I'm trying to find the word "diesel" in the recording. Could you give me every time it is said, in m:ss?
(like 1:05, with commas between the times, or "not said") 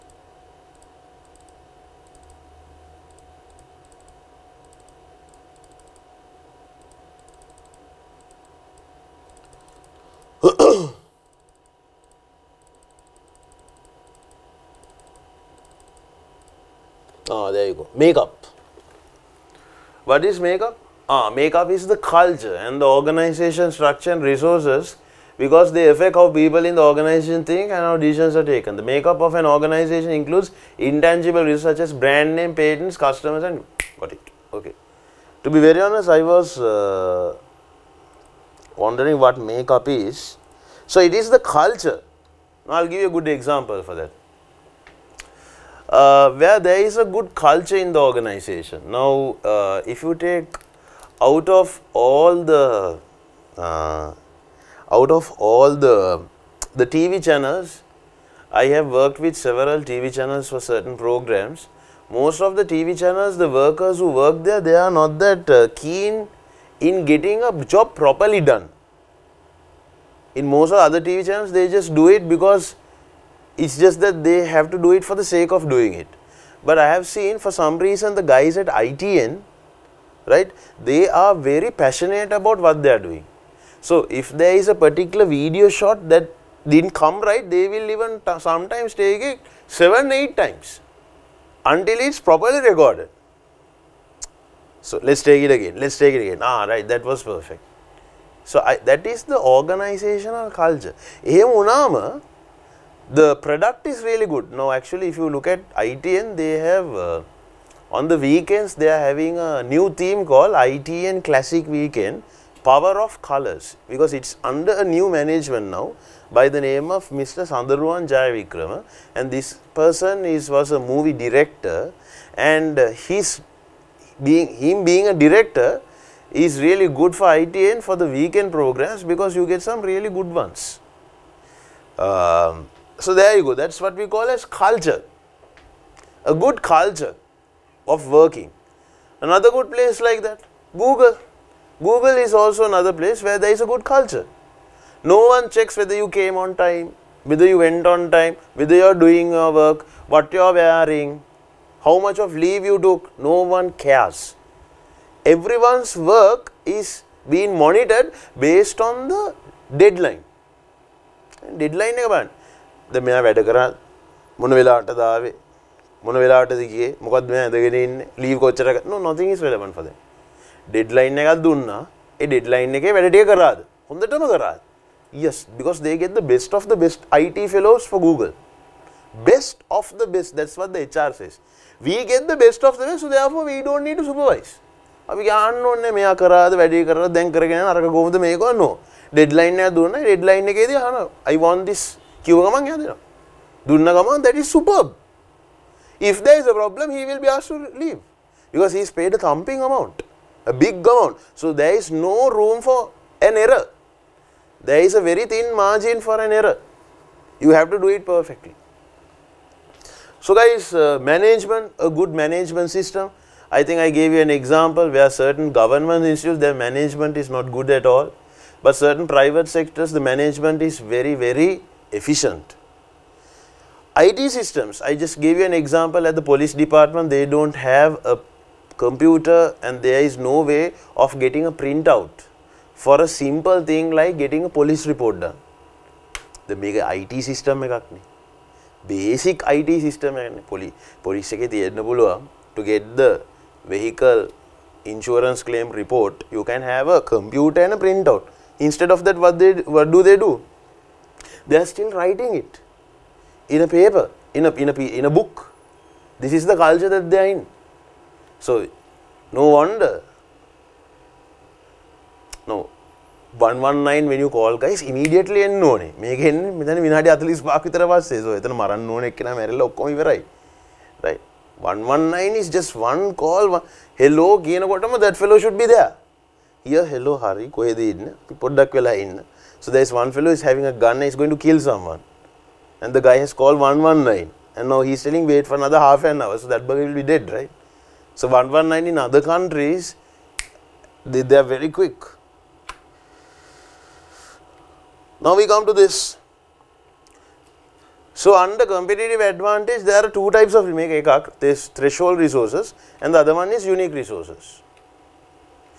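not said.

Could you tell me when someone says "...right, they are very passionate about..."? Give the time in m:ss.
1:20.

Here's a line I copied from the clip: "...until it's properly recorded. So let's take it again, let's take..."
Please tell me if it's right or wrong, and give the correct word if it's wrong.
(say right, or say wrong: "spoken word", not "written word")
right.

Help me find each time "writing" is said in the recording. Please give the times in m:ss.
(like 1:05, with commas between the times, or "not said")
4:11.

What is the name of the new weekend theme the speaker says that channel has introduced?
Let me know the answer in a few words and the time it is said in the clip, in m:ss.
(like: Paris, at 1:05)
ITN Classic Weekend Power of Colors, at 1:50.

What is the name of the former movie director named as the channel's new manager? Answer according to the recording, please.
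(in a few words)
Sandaruan Jayavikrama.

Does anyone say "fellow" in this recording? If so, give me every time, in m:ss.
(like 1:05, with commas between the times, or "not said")
2:57, 4:35, 4:40.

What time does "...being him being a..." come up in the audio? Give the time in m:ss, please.
2:04.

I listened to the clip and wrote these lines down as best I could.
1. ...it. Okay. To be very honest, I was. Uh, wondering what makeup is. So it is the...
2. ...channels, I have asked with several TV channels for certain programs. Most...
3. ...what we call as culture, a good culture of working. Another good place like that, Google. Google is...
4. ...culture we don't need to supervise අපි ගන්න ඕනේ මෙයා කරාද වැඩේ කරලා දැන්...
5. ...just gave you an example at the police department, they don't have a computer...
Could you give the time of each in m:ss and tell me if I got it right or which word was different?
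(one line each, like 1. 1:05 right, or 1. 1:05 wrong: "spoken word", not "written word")
1. 0:34 right
2. 0:57 wrong: "worked", not "asked"
3. 2:13 right
4. 3:03 wrong: "therefore", not "culture"
5. 3:44 right.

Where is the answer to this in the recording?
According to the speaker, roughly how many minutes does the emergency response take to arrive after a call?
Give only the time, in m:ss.
4:26.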